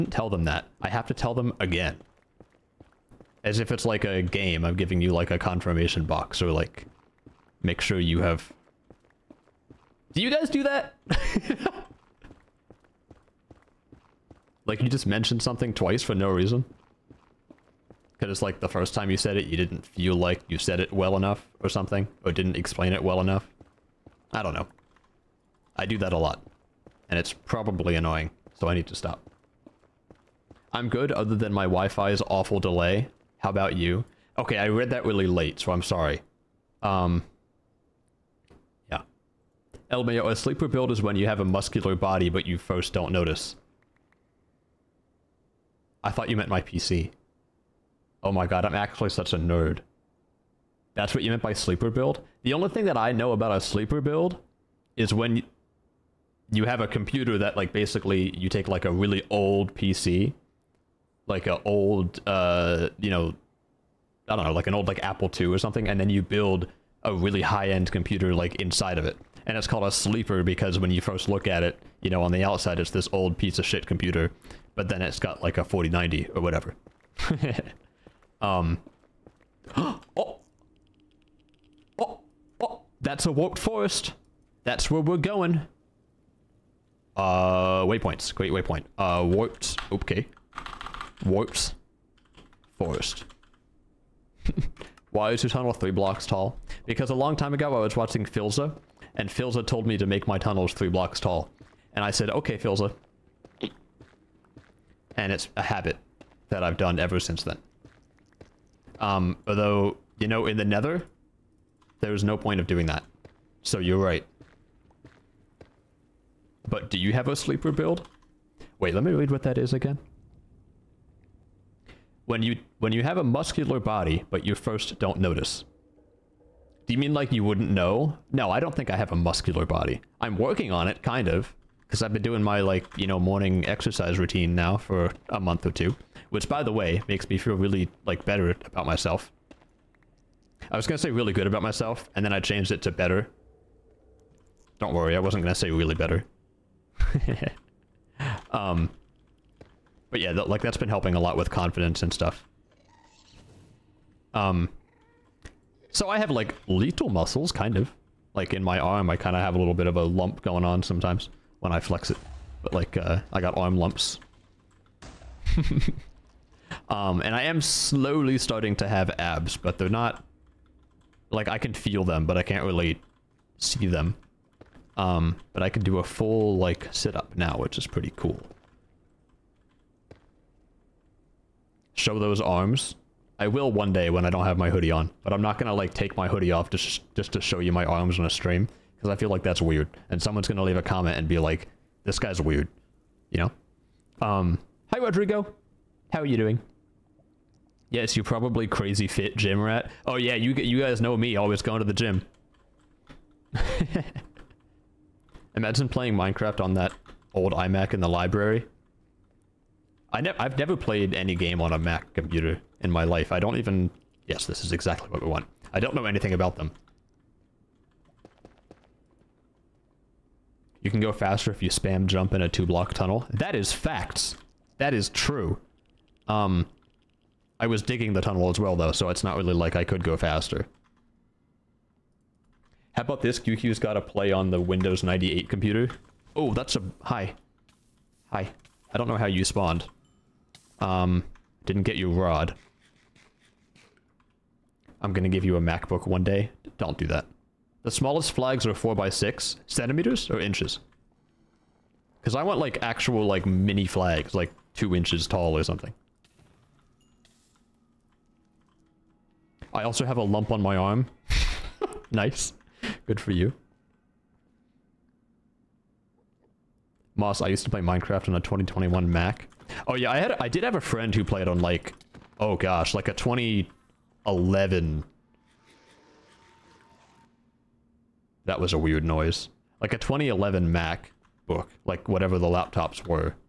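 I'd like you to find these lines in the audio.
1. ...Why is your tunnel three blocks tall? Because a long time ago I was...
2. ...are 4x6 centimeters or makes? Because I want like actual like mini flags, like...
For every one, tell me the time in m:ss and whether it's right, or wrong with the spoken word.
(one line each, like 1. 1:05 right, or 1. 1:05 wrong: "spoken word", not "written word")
1. 1:35 right
2. 4:08 wrong: "inches", not "makes".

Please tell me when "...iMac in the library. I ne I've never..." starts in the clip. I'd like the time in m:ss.
3:27.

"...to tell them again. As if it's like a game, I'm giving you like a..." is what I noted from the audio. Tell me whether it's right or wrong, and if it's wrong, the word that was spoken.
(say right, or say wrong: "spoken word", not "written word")
right.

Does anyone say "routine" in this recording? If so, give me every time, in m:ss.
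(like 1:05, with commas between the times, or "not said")
2:14.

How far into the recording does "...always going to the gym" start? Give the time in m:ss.
3:21.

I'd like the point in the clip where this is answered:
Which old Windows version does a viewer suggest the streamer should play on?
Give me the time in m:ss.
3:54.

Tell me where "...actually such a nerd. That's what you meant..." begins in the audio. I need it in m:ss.
0:48.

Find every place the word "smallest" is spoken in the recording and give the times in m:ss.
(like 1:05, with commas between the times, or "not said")
4:07.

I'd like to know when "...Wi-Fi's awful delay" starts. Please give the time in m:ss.
0:31.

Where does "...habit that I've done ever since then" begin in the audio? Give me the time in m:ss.
1:45.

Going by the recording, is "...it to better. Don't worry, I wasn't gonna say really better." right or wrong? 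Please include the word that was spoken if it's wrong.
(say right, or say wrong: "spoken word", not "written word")
right.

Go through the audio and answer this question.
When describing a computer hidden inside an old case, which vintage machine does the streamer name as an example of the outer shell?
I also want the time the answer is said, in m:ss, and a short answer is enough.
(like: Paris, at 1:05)
Apple II, at 1:05.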